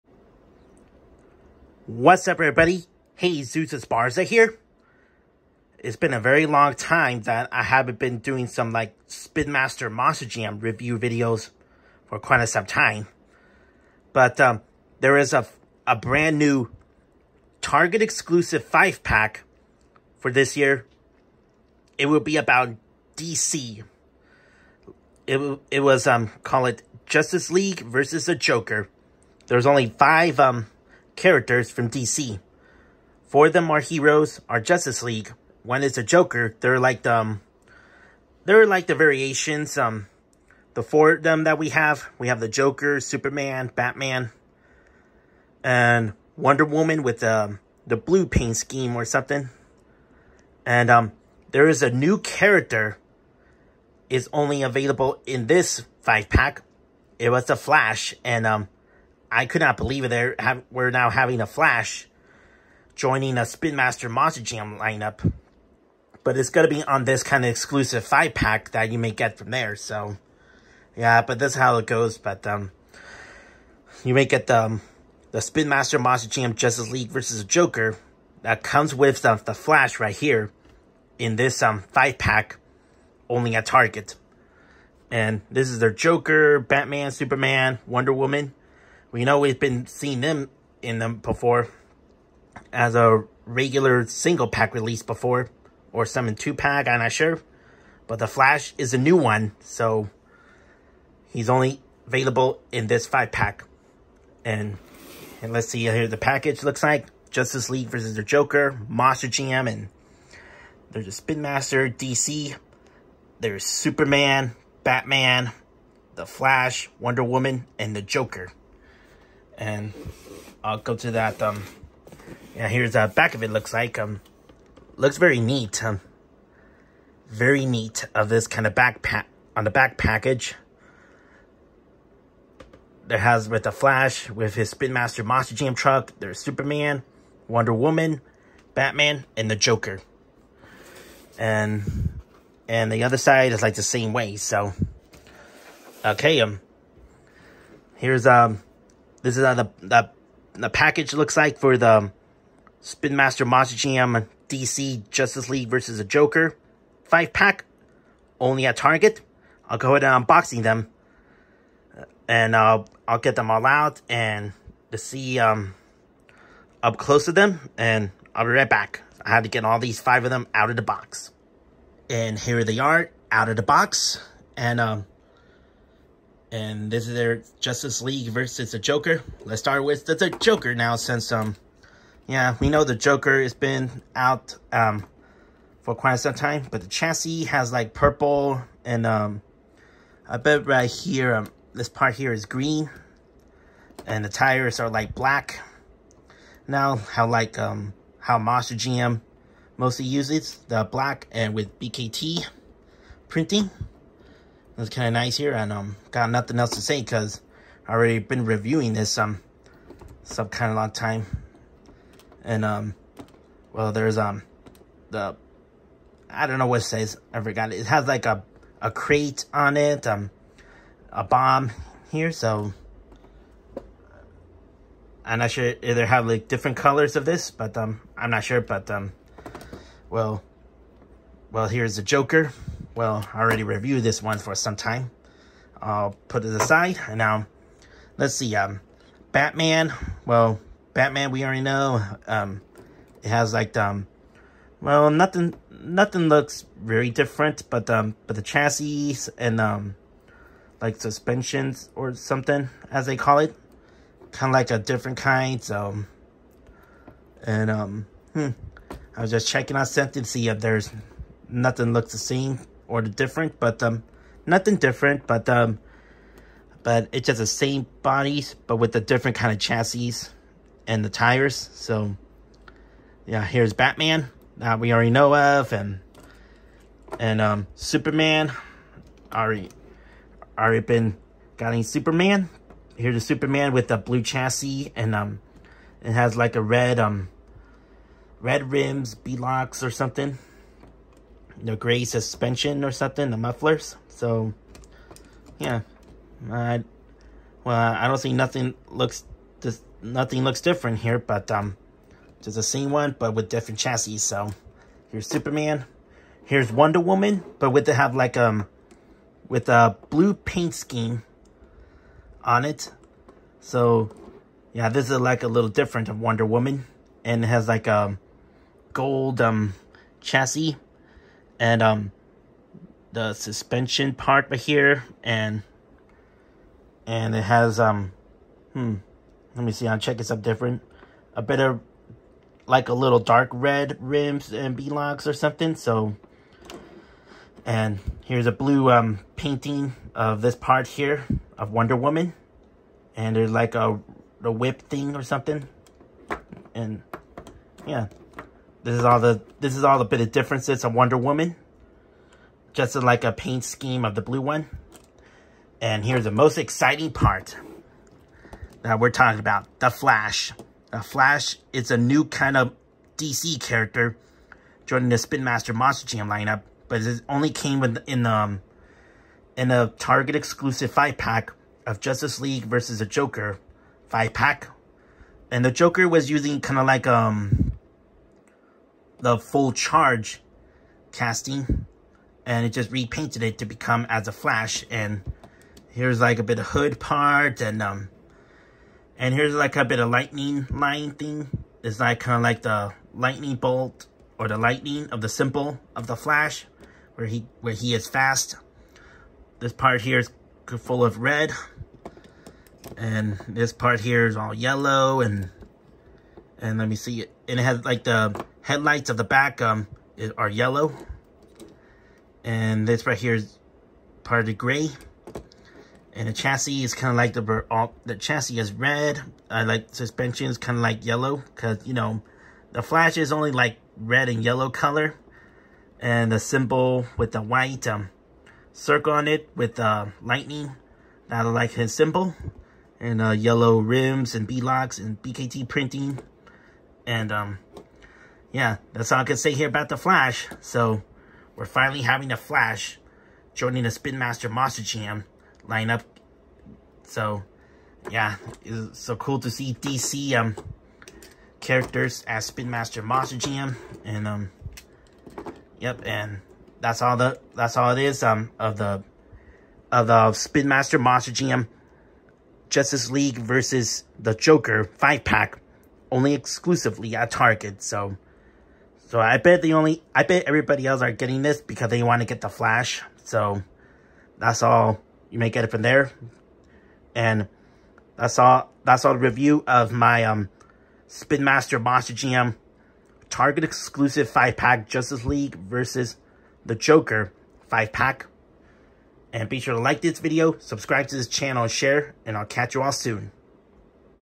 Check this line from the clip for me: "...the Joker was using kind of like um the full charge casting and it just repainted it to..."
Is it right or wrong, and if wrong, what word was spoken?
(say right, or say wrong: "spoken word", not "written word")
right.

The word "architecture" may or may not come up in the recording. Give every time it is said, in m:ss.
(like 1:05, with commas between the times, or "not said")
not said.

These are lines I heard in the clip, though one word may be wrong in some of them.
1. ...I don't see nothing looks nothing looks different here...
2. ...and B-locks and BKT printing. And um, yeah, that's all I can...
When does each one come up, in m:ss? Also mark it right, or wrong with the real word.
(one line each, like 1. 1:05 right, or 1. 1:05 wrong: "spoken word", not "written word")
1. 4:57 right
2. 7:14 right.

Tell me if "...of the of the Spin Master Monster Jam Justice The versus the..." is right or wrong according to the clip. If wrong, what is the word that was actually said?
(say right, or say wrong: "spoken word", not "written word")
wrong: "League", not "The".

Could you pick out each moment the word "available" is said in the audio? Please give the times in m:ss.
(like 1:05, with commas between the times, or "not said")
0:54, 1:42.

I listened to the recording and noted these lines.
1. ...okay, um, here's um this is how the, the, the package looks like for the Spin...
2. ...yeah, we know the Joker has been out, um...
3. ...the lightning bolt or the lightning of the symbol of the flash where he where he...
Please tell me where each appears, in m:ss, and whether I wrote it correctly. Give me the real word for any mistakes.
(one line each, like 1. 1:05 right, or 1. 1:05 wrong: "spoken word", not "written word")
1. 2:26 right
2. 3:02 right
3. 6:32 right.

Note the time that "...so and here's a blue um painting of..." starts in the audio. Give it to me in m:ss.
5:35.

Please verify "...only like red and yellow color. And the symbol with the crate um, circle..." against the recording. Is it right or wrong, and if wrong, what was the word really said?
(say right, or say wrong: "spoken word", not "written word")
wrong: "white", not "crate".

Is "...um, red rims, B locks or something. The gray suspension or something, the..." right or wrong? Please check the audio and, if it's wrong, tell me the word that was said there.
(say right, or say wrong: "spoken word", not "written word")
right.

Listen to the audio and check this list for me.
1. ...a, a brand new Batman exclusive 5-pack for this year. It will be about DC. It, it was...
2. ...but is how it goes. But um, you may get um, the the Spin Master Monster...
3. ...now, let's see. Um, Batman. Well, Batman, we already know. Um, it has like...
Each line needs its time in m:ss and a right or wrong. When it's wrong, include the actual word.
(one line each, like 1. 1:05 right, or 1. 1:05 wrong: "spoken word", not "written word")
1. 0:15 wrong: "Target", not "Batman"
2. 1:11 right
3. 3:57 right.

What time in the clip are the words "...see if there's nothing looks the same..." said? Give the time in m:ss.
4:20.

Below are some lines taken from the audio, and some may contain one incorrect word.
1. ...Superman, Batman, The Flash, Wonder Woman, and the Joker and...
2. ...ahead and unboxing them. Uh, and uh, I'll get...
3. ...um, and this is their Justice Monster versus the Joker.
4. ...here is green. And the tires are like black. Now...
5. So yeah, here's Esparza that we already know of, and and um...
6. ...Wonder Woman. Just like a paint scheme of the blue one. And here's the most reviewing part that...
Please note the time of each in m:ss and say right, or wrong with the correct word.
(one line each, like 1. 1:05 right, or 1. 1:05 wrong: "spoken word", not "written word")
1. 1:53 right
2. 2:39 right
3. 2:54 wrong: "League", not "Monster"
4. 3:12 right
5. 4:31 wrong: "Batman", not "Esparza"
6. 5:50 wrong: "exciting", not "reviewing".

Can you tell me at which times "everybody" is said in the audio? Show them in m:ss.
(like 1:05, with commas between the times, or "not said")
0:02, 7:50.